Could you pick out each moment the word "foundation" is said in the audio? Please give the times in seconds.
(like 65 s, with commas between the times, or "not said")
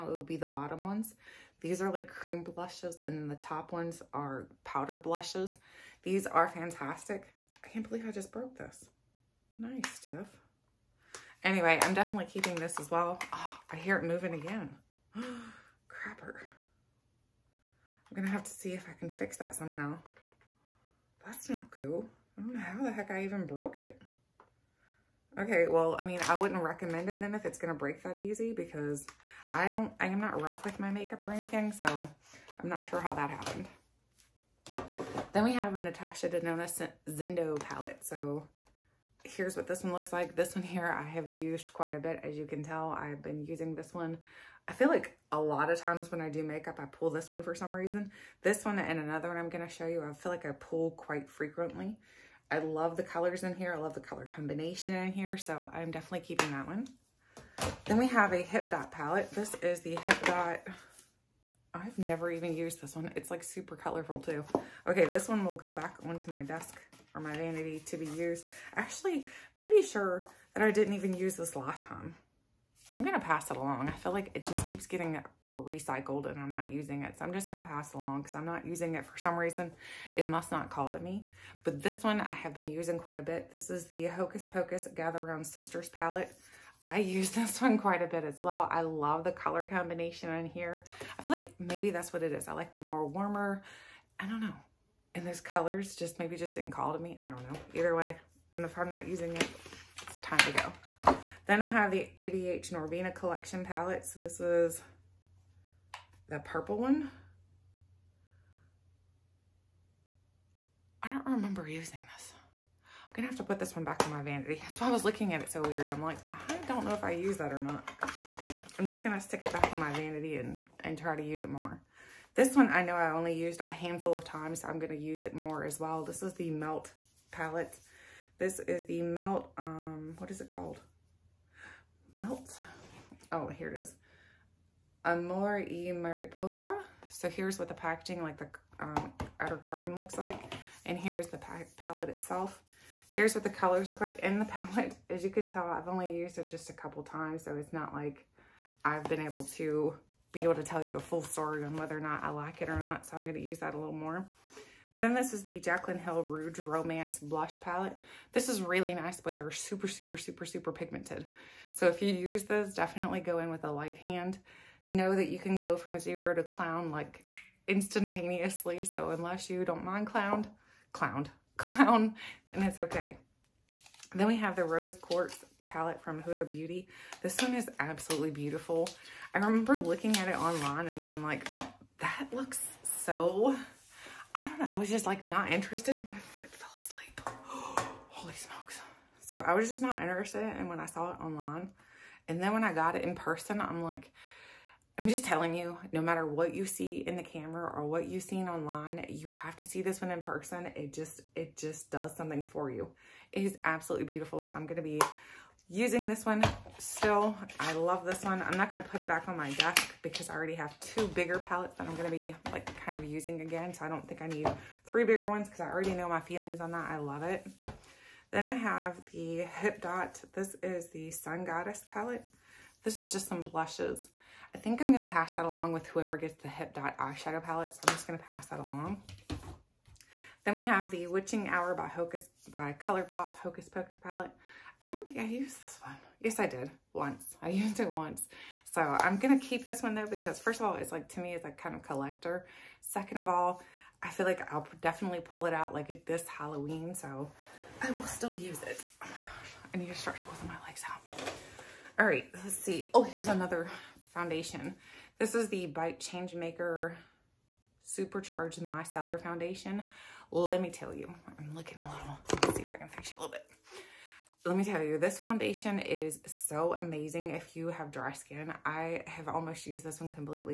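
254 s, 259 s, 265 s.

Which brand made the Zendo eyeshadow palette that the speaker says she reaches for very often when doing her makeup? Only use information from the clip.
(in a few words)
Natasha Denona.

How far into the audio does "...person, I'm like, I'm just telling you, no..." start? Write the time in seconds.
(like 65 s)
193 s.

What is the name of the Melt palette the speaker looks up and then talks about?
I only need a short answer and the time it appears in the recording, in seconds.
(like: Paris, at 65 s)
Amor y Mariposa, at 135 s.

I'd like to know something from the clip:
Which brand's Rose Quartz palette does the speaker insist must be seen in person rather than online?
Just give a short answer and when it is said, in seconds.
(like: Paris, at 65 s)
Huda Beauty, at 176 s.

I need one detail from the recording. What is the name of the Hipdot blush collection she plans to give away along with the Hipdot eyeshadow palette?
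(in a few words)
Sun Goddess.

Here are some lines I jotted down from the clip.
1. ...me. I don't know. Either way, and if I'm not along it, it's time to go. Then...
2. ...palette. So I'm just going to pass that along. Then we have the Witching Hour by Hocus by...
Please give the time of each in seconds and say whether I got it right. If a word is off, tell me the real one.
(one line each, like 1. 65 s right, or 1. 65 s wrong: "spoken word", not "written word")
1. 96 s wrong: "using", not "along"
2. 227 s right.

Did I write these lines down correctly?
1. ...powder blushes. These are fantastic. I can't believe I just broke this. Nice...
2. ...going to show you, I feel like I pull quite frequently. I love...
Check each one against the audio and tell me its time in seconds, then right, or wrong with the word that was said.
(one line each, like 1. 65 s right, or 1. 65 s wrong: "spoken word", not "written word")
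1. 4 s right
2. 49 s right.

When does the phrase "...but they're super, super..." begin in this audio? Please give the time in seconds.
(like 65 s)
159 s.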